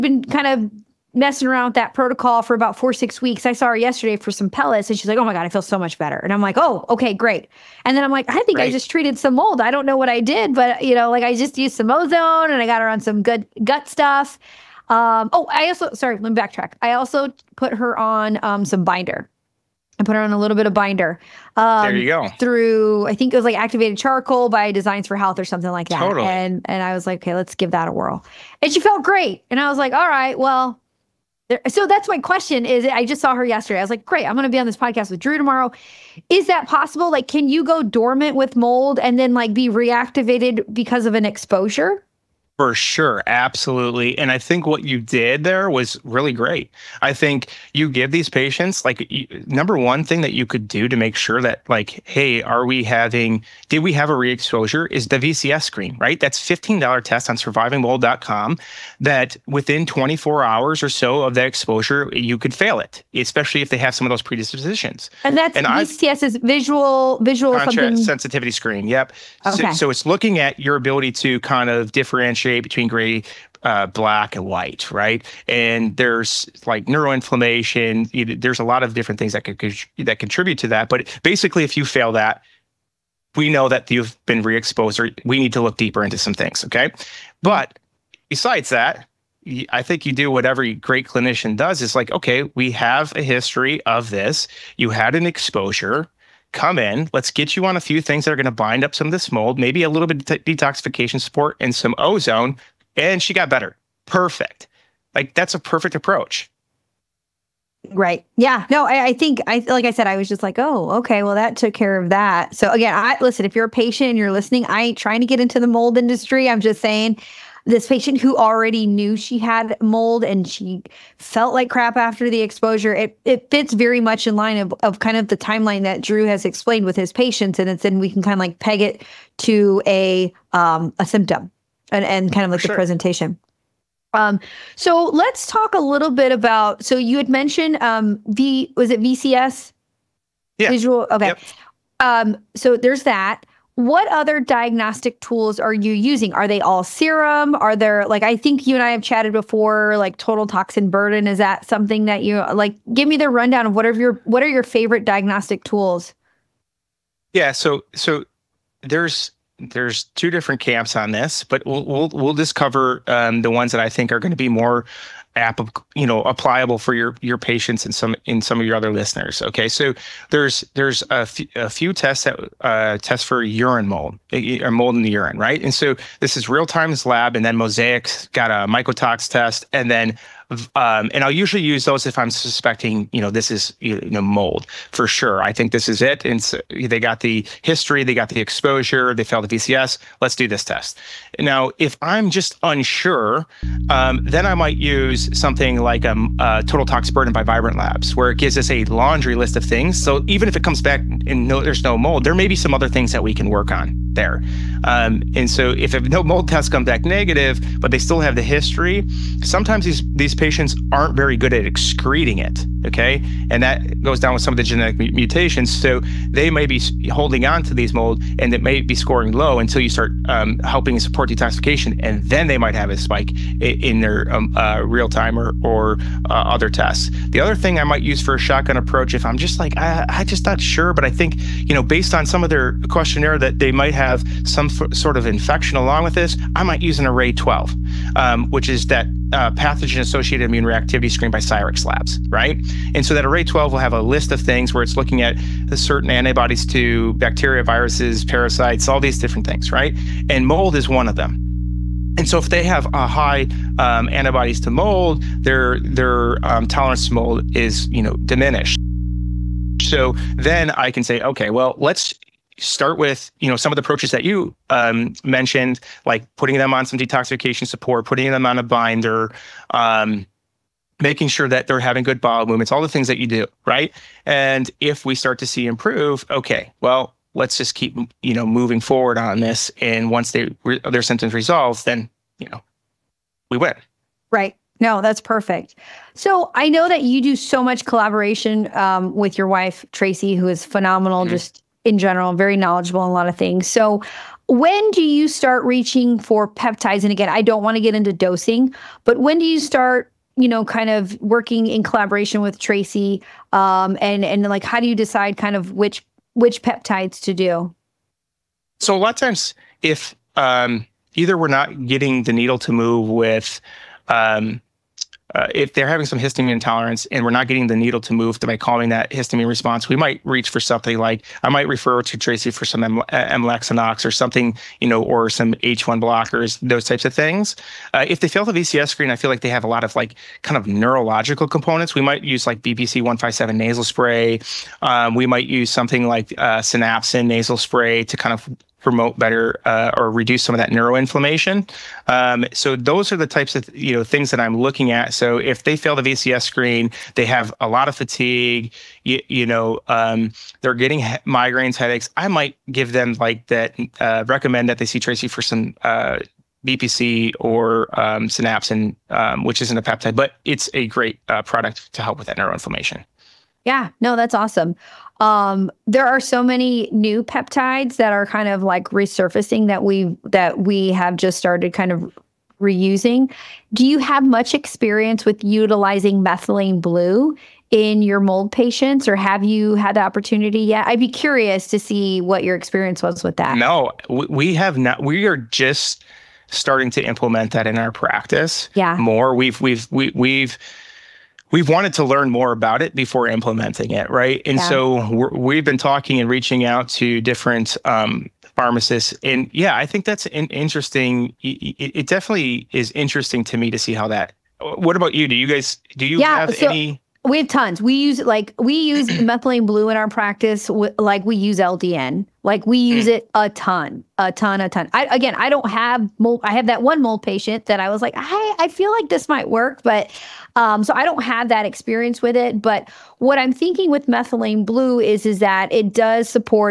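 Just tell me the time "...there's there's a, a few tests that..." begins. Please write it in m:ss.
2:50.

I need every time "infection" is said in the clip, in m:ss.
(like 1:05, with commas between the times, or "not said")
3:55.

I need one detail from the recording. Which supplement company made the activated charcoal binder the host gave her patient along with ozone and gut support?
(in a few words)
Designs for Health.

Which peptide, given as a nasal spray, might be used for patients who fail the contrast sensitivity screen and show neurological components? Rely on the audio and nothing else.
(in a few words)
BPC 157.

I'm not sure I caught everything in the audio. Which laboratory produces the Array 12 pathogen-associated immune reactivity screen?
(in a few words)
Cyrex Labs.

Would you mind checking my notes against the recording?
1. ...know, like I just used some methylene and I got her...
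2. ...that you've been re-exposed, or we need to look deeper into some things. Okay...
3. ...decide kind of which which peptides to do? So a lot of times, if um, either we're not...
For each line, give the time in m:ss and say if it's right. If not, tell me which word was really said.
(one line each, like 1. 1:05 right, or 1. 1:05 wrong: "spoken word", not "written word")
1. 0:10 wrong: "ozone", not "methylene"
2. 1:23 right
3. 5:04 right.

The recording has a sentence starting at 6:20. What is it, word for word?
I'd be curious to see what your experience was with that.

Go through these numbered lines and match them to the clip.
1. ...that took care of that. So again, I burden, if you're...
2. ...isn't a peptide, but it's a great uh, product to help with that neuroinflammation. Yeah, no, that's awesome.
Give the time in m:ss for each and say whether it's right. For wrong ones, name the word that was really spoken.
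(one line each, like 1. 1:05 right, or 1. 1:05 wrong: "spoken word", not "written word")
1. 1:51 wrong: "listen", not "burden"
2. 5:59 right.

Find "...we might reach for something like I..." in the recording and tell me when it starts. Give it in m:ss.
5:19.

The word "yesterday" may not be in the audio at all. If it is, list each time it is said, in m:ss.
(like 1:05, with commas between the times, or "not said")
0:03, 0:33.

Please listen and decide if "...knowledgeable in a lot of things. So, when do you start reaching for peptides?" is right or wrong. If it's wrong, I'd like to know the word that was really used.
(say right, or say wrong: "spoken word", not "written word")
right.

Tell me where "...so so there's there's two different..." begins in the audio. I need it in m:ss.
2:37.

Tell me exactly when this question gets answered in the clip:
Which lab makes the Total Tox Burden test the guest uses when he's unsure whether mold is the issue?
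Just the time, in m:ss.
3:17.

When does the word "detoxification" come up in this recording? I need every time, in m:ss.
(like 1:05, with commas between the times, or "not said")
1:40, 3:41, 4:26.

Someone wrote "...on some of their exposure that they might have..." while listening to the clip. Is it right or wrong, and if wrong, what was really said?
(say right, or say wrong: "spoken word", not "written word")
wrong: "questionnaire", not "exposure".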